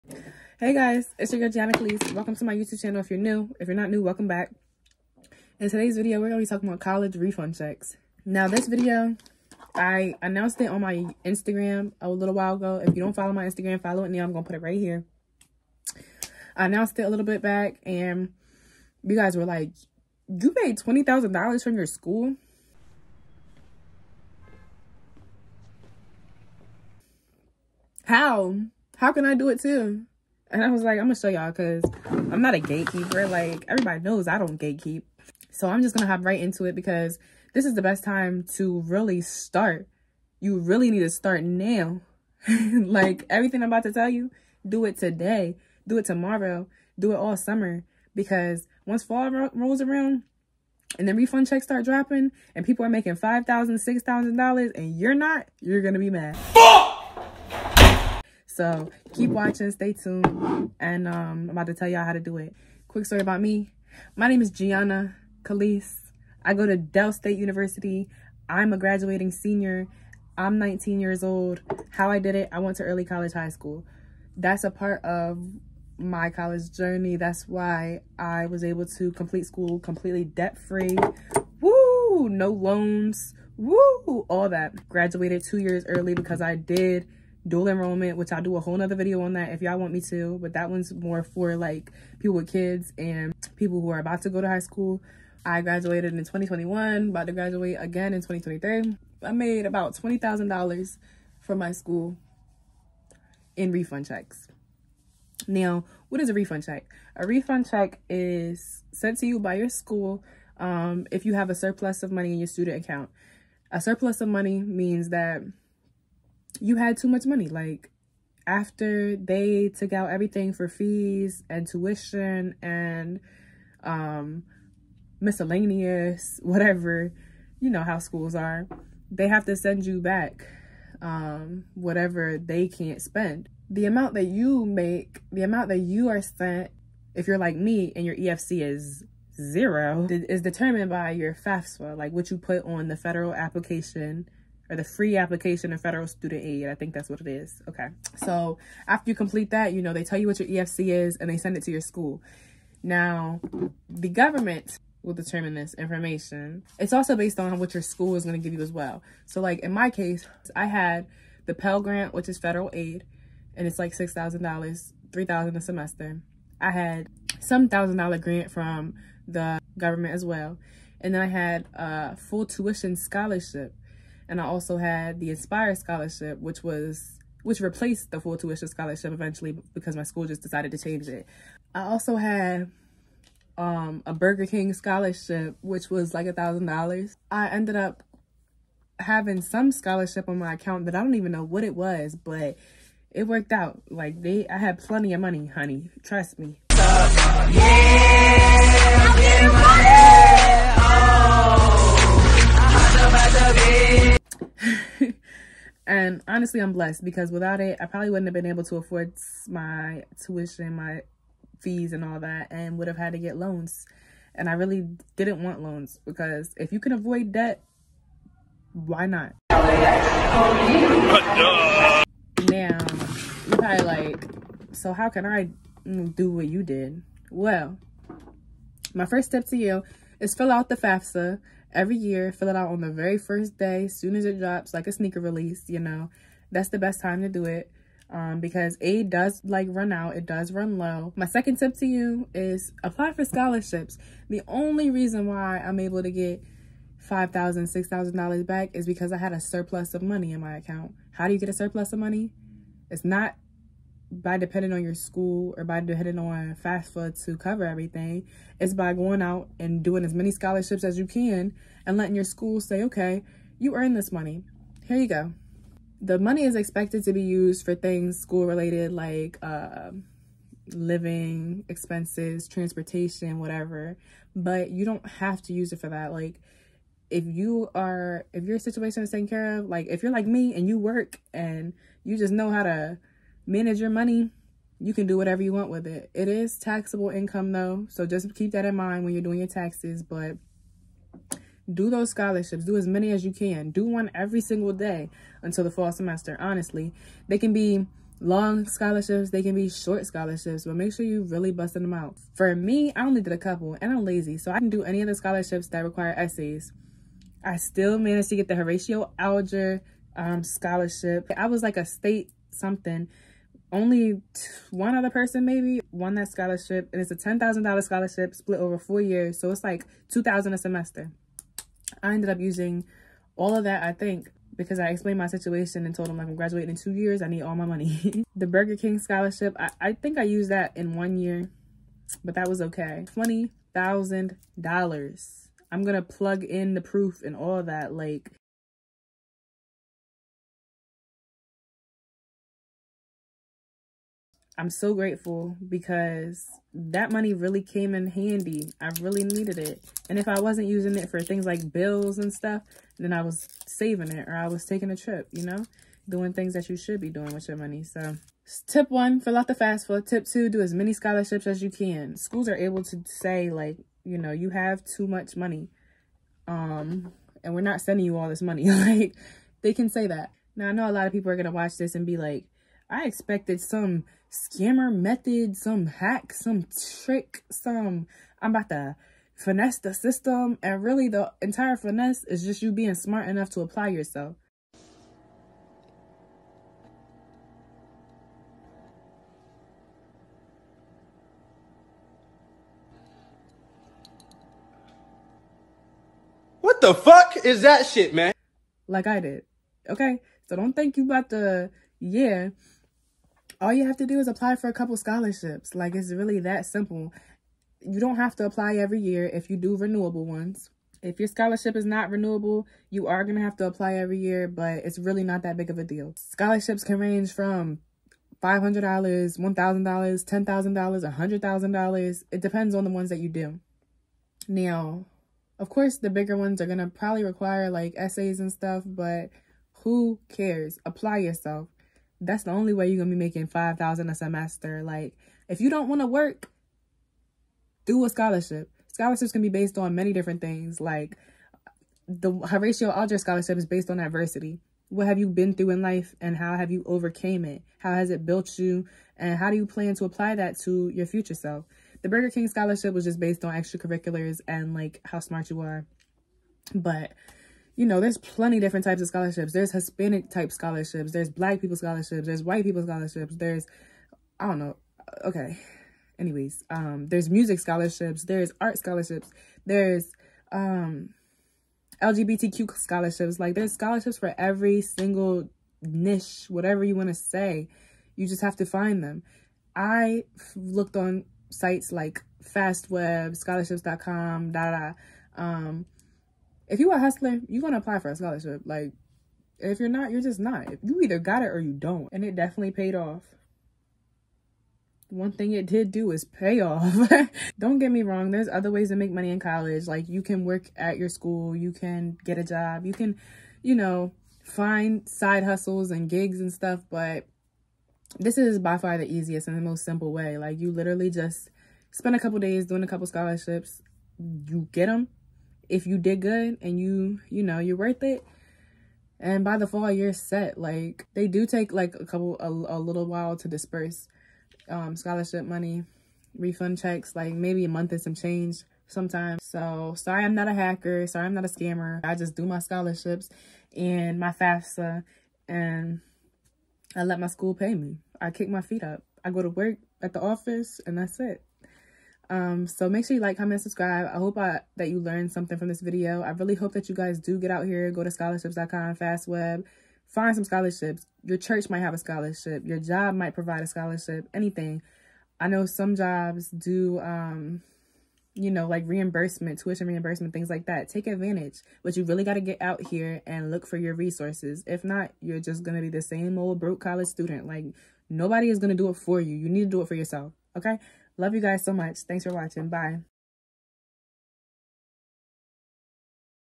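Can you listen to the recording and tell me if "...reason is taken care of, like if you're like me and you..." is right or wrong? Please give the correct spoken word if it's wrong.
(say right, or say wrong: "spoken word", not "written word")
wrong: "situation", not "reason".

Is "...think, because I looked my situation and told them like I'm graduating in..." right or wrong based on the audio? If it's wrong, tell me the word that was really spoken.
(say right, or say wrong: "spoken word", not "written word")
wrong: "explained", not "looked".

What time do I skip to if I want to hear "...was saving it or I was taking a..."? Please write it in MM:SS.
05:53.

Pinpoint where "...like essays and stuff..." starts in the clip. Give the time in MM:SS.
07:07.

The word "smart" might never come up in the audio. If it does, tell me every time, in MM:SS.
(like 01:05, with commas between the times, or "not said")
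06:22, 07:35.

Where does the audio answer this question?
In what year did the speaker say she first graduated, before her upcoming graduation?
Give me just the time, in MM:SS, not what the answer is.
01:36.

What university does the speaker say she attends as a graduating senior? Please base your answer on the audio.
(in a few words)
Del State University.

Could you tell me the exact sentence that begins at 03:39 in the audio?
now, you probably like, so how can I mm, do what you did?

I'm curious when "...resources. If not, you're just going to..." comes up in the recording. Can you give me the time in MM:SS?
09:23.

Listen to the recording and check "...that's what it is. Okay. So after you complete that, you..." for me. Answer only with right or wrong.
right.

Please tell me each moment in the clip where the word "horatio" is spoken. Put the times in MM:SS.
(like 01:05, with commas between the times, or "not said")
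05:08, 07:22.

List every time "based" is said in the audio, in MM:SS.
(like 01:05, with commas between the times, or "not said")
02:37, 07:19, 07:23, 07:33.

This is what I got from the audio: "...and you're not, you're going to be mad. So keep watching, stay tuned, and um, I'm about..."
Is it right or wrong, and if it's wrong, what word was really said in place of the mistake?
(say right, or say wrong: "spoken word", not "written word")
right.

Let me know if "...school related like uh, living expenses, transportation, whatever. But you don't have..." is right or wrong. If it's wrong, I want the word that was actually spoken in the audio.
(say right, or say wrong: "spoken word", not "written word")
right.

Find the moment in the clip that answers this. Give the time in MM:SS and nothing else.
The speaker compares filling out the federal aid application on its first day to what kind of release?
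03:54.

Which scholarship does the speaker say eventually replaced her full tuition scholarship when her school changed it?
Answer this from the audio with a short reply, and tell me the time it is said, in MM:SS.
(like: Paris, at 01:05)
Inspire Scholarship, at 02:55.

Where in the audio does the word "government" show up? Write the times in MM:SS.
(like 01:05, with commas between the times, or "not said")
02:34, 02:49.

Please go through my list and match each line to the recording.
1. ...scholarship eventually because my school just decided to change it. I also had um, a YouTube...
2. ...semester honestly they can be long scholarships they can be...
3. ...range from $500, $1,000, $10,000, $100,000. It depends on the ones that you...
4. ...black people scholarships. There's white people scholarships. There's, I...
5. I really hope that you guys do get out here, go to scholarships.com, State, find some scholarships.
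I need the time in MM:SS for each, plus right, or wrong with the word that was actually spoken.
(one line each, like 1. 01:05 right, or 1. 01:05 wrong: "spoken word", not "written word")
1. 02:58 wrong: "Burger", not "YouTube"
2. 04:55 right
3. 06:56 right
4. 07:41 right
5. 09:06 wrong: "FastWeb", not "State".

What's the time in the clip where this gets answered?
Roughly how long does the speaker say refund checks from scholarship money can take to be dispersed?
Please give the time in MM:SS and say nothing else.
08:47.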